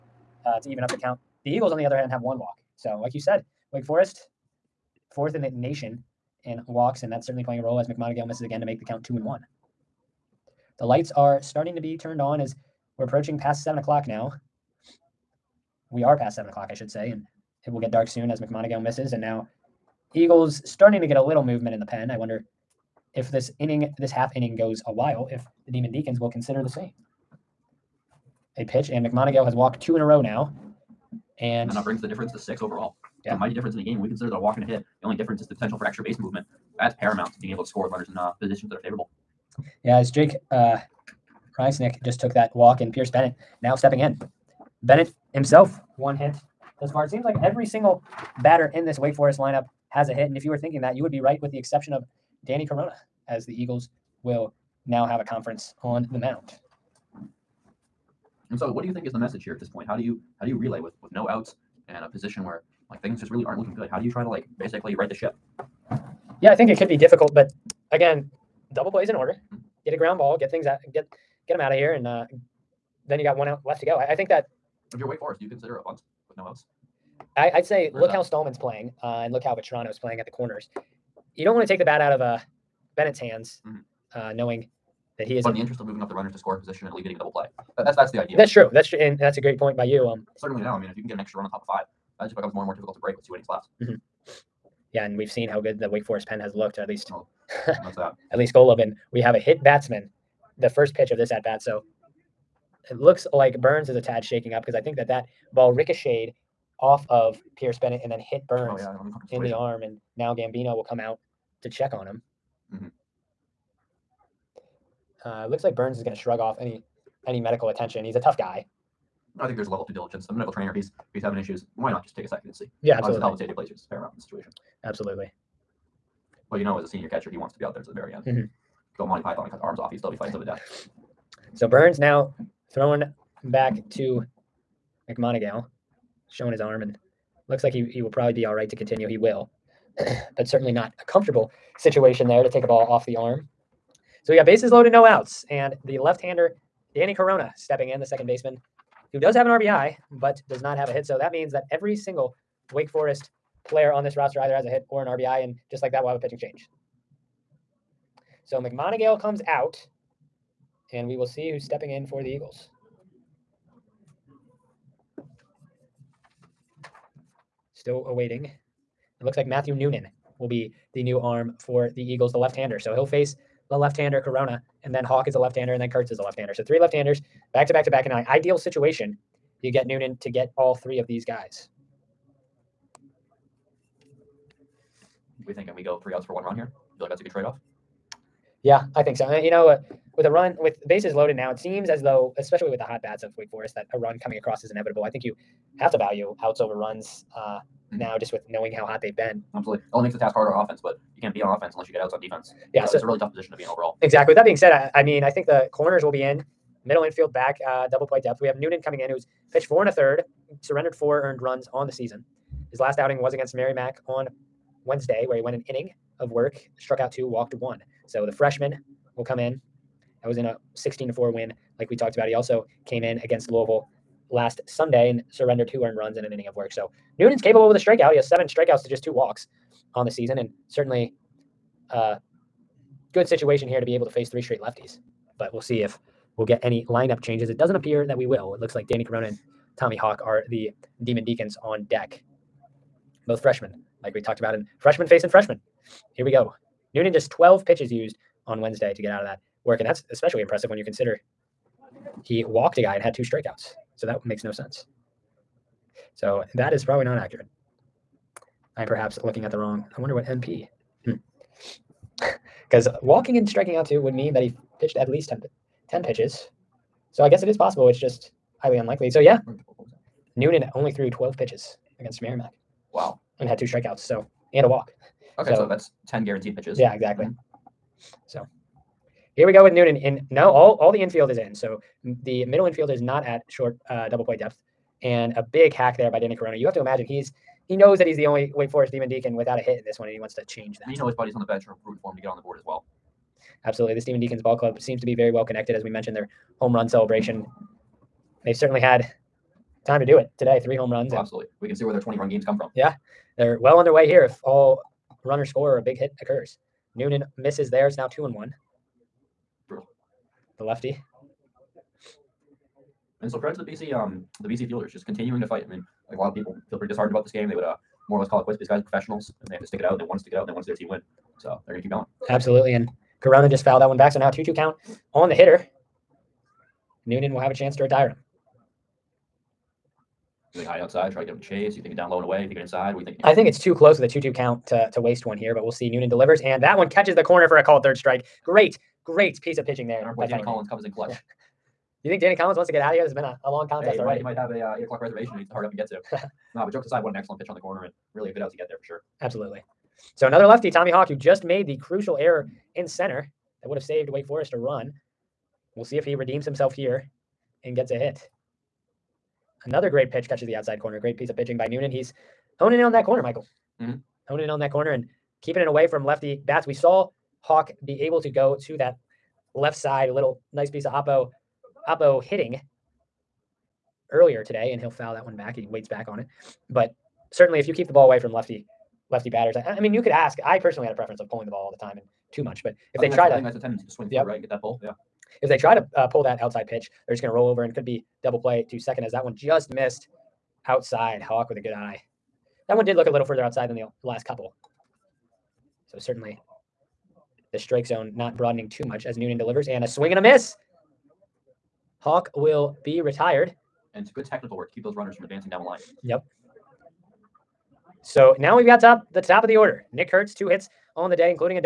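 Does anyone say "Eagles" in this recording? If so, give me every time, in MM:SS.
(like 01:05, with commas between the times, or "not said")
00:01, 00:20, 00:53, 02:42, 02:52.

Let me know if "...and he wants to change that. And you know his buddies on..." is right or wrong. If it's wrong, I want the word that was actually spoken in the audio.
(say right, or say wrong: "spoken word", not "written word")
right.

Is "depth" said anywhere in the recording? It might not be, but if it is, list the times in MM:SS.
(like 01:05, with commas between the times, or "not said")
03:28, 04:44.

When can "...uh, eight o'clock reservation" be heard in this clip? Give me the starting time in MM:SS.
05:44.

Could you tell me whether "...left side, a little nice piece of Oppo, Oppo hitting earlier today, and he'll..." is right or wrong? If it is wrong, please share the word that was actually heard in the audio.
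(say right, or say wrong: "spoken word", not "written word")
right.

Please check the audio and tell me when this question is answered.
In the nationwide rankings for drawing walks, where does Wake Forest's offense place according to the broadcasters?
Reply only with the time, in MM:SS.
00:05.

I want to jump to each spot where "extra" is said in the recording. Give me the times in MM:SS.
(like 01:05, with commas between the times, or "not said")
00:35, 01:31.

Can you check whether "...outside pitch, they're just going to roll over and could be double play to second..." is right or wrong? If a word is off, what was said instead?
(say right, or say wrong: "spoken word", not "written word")
right.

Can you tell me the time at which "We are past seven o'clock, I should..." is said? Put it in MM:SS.
00:15.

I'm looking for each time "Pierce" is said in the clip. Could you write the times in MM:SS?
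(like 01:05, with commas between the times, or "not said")
00:42, 01:47.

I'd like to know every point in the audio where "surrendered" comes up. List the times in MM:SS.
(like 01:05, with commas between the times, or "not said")
03:30, 03:45.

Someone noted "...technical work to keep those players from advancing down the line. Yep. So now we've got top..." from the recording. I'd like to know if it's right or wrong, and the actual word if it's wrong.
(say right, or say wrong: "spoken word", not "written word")
wrong: "runners", not "players".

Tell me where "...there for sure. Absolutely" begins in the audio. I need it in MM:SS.
05:48.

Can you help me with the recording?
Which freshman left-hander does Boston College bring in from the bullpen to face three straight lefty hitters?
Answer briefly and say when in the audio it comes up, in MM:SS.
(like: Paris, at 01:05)
Matthew Noonan, at 02:49.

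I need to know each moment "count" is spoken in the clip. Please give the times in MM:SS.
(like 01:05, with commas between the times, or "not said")
00:00, 00:08, 05:24, 05:34.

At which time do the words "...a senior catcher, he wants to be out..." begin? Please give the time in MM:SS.
02:06.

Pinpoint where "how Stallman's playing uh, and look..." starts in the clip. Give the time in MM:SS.
01:18.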